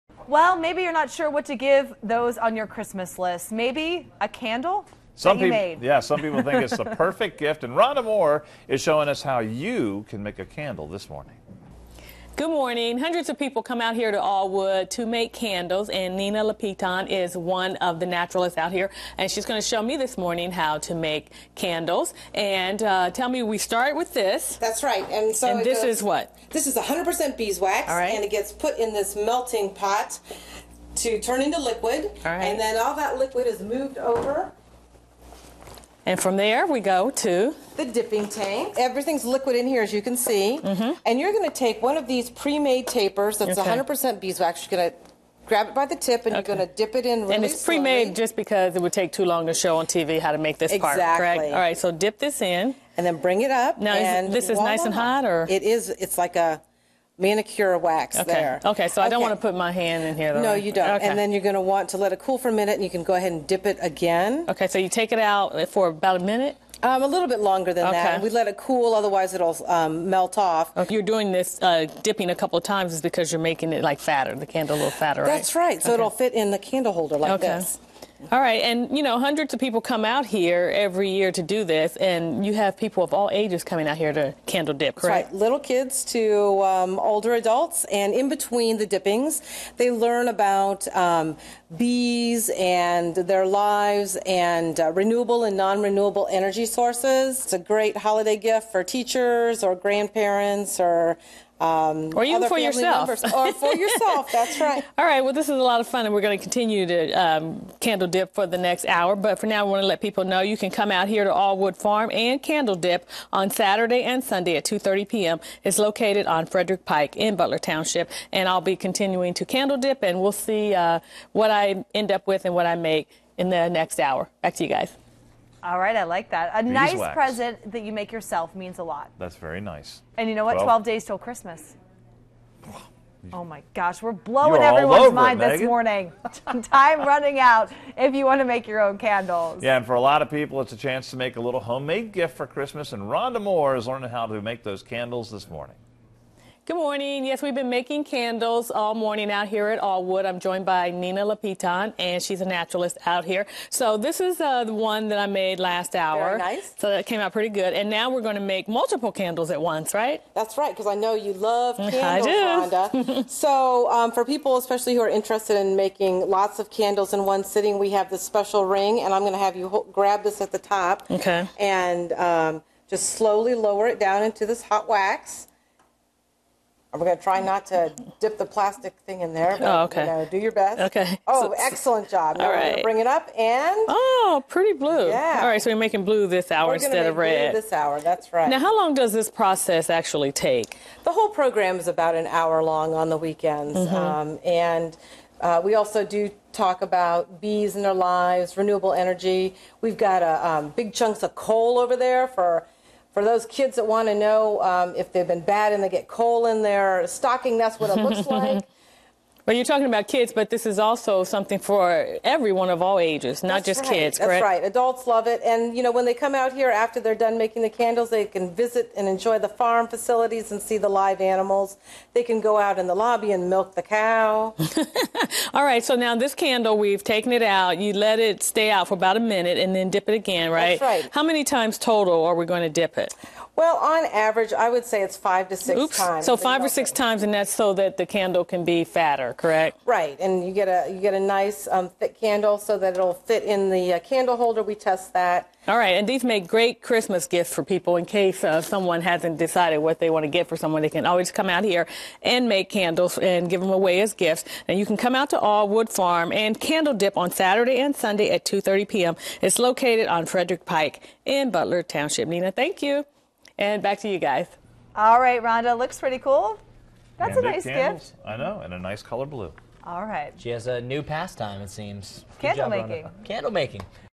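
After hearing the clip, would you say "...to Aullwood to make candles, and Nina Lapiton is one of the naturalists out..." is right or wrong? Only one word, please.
right.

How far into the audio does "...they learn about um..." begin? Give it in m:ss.
1:29.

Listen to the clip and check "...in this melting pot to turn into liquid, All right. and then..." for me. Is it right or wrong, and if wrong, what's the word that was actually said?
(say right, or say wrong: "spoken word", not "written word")
right.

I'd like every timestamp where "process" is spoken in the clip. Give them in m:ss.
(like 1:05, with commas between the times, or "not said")
3:09.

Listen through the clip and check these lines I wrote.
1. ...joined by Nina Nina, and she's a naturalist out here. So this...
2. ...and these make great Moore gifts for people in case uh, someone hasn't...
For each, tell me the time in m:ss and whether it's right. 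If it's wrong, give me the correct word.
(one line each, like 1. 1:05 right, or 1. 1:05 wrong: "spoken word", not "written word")
1. 2:30 wrong: "Lapiton", not "Nina"
2. 4:05 wrong: "Christmas", not "Moore".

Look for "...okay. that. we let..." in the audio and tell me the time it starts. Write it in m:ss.
1:07.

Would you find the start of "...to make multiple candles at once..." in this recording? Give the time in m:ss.
2:38.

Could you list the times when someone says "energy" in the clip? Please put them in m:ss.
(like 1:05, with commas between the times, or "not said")
1:36, 3:18.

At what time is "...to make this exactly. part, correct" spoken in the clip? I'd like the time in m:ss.
0:50.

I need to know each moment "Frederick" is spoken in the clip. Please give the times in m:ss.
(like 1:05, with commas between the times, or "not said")
1:56, 4:20.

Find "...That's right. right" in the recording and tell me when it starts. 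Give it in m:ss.
1:15.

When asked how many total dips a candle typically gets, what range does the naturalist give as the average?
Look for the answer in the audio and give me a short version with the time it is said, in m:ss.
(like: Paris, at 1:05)
5 to 6, at 3:55.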